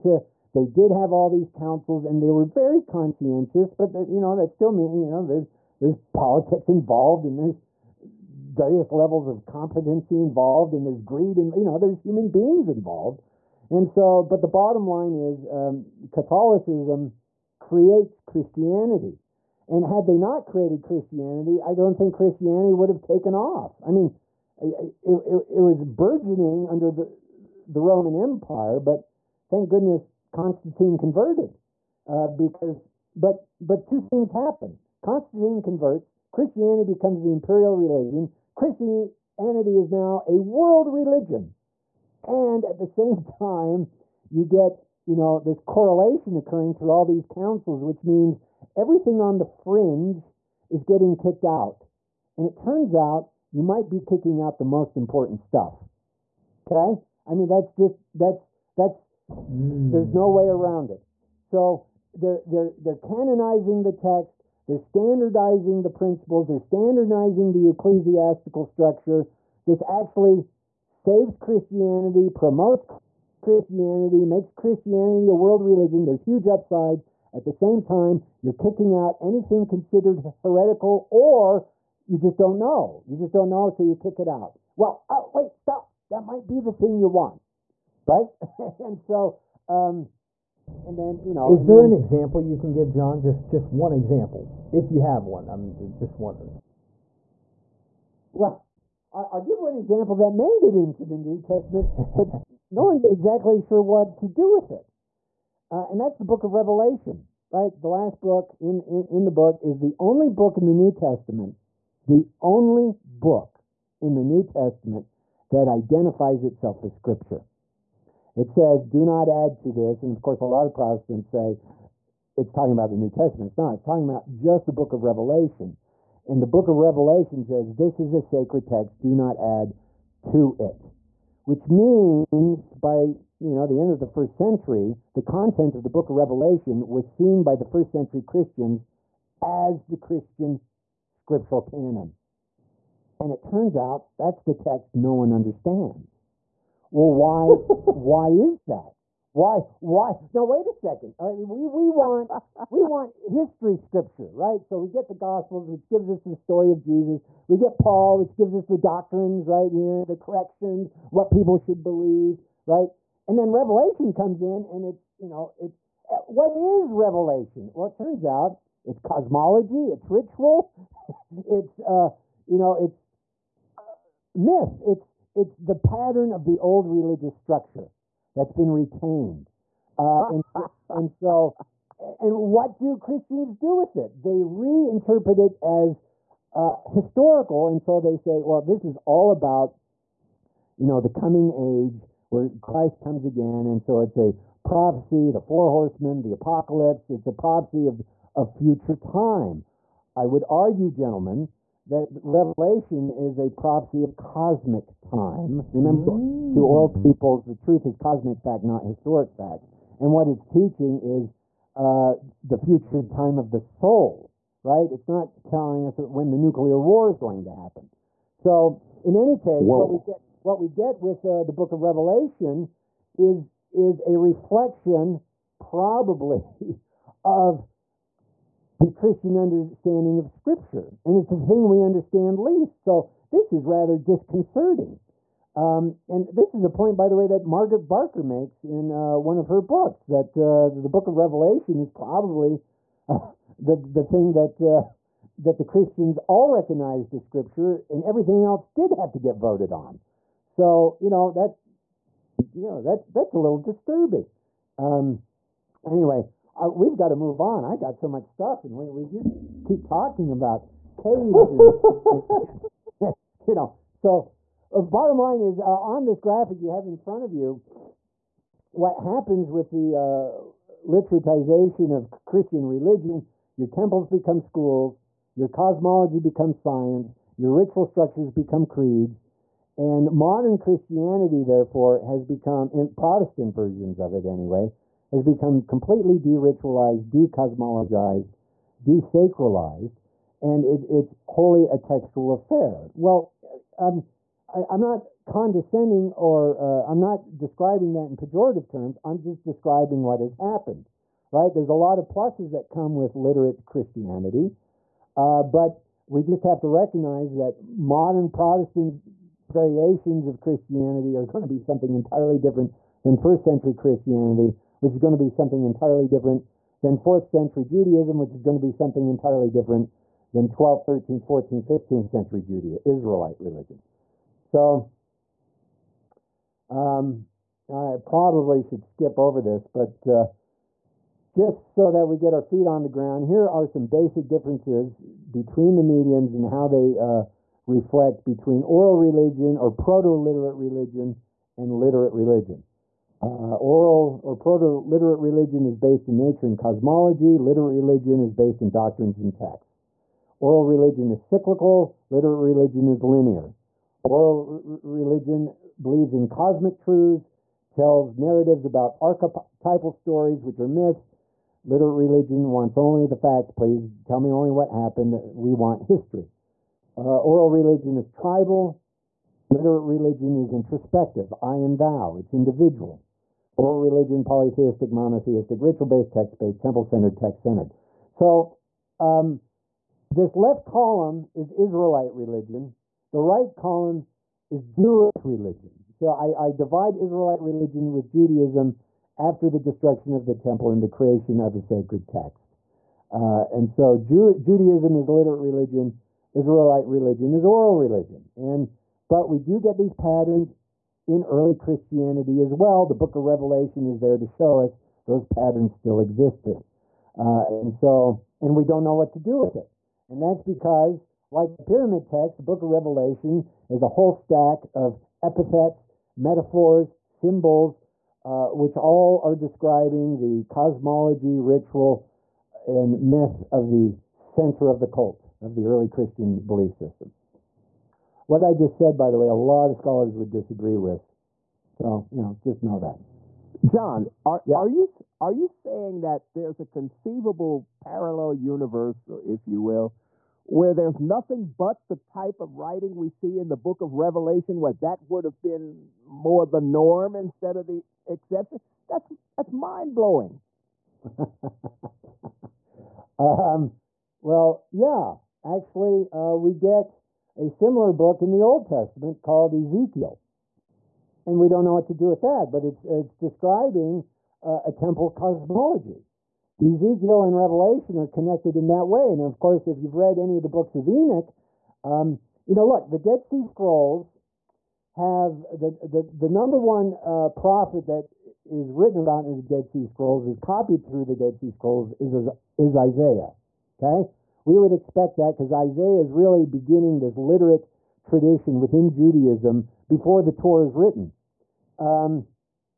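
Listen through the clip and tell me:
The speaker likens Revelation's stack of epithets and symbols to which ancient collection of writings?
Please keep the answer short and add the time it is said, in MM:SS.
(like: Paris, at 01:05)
the pyramid text, at 06:51.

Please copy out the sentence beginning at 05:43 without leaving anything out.
Uh, oral or proto literate religion is based in nature and cosmology, literate religion is based in doctrines and texts.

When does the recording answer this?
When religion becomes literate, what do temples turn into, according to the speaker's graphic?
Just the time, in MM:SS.
04:34.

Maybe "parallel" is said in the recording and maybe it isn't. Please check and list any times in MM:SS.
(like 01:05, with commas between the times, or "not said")
07:17.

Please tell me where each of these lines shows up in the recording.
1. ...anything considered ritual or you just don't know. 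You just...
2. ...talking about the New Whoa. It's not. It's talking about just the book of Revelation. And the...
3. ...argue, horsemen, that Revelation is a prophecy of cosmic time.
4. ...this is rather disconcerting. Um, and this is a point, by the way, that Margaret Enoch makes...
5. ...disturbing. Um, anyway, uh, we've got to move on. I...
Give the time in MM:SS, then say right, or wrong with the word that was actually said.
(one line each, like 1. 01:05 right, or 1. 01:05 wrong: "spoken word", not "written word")
1. 01:19 wrong: "heretical", not "ritual"
2. 02:02 wrong: "Testament", not "Whoa"
3. 03:20 wrong: "gentlemen", not "horsemen"
4. 03:53 wrong: "Barker", not "Enoch"
5. 04:13 right.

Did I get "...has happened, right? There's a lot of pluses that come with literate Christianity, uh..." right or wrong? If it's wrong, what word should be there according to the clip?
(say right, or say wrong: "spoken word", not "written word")
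right.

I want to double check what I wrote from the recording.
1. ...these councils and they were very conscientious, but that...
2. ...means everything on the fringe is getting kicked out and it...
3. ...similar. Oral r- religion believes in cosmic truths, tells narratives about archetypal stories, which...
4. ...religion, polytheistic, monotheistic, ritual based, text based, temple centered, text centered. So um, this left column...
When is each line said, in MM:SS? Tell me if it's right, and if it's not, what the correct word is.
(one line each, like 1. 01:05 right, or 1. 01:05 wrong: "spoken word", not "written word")
1. 00:01 right
2. 00:48 right
3. 05:53 wrong: "linear", not "similar"
4. 06:13 right.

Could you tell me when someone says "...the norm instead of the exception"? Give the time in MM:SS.
07:26.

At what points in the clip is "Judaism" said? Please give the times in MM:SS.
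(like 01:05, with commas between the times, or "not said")
05:17, 06:28, 06:34, 08:08.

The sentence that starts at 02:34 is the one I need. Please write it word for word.
So we get the Gospels, which gives us the story of Jesus.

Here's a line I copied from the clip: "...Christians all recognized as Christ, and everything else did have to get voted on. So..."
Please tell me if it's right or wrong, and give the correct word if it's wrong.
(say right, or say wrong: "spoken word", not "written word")
wrong: "Scripture", not "Christ".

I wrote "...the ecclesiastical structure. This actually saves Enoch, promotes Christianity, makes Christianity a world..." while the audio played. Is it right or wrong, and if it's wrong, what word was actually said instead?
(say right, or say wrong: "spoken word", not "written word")
wrong: "Christianity", not "Enoch".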